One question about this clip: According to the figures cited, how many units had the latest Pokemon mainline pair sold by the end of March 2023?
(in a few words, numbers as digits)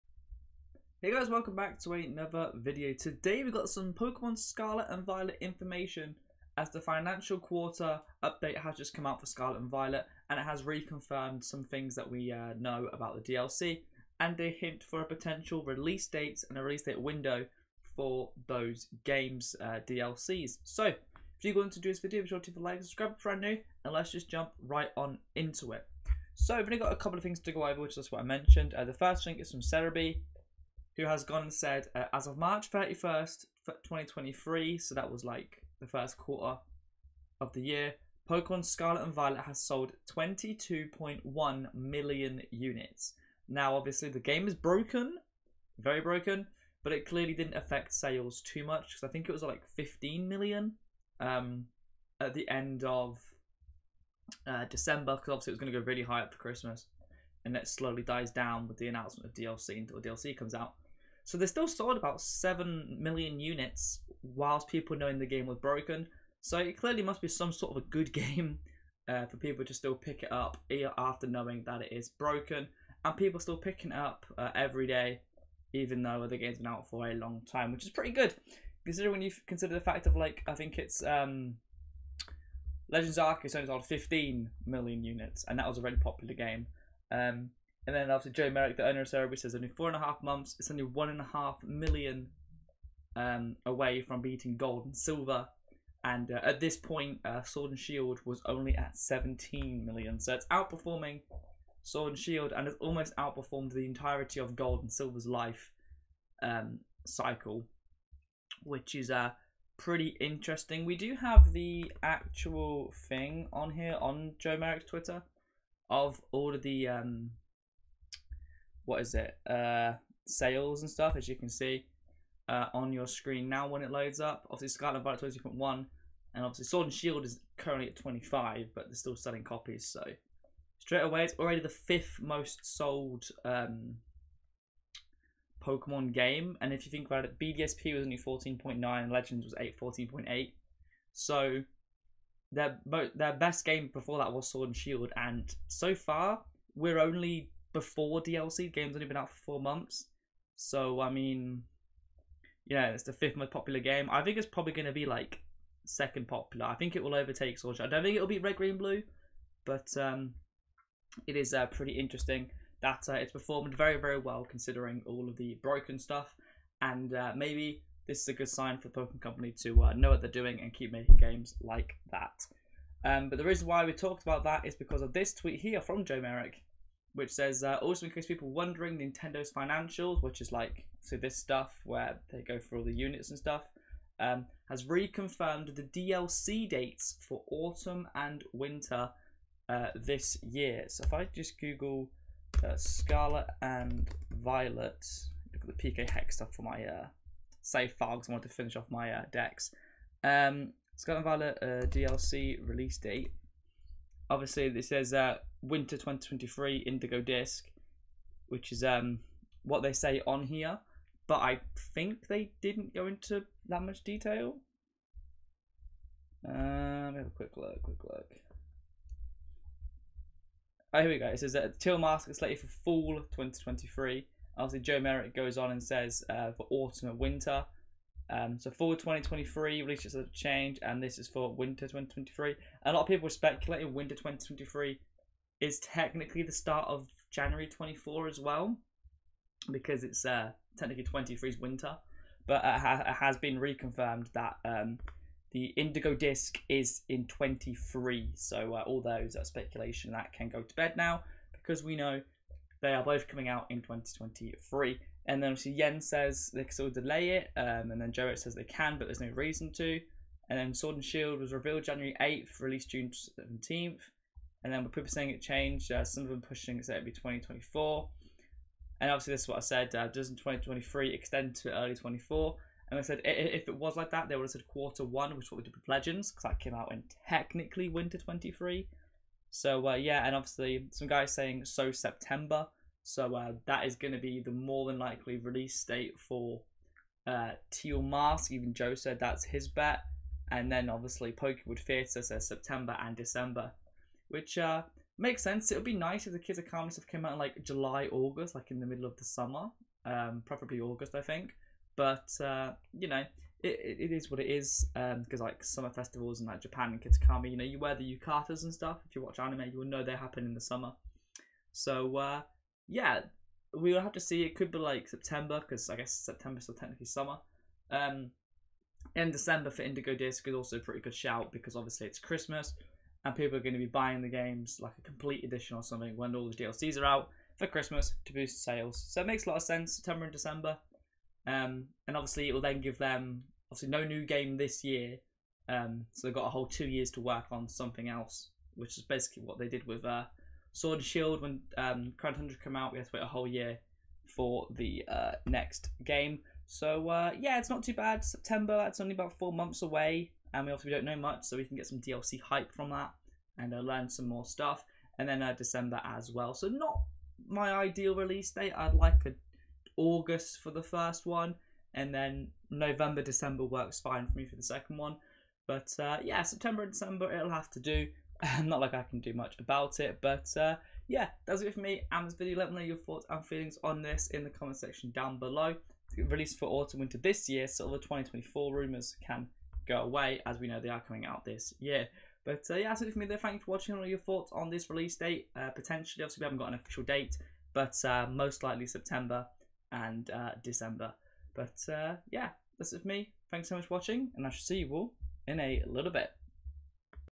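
22.1 million.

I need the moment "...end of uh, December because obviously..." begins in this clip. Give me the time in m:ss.
0:52.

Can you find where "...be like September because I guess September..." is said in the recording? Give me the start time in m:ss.
5:14.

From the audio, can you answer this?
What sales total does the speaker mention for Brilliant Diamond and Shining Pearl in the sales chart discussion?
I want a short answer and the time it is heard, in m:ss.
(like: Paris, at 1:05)
14.9, at 2:18.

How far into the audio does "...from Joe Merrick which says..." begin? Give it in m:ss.
2:55.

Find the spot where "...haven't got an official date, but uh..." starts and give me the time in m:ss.
6:26.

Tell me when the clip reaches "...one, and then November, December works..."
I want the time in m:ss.
6:01.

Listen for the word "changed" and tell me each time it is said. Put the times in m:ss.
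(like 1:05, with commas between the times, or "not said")
3:50, 4:25.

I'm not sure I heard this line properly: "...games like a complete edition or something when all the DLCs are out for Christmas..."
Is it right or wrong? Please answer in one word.
right.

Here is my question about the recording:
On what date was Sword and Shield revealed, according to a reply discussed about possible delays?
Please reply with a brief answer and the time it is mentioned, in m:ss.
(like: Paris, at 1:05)
January 8th, at 4:21.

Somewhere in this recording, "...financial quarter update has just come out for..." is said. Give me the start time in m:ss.
0:06.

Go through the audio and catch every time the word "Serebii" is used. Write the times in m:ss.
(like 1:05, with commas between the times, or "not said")
0:29, 1:29.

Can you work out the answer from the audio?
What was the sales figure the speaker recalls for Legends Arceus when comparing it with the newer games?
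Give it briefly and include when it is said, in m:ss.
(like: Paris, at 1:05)
15 million, at 1:23.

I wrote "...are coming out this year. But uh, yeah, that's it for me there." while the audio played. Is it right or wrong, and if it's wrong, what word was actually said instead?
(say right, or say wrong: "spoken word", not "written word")
right.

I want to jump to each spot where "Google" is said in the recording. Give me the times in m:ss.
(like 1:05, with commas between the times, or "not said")
3:11.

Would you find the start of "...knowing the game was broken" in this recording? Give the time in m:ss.
1:04.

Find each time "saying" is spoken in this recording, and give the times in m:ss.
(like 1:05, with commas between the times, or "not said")
4:25, 4:41.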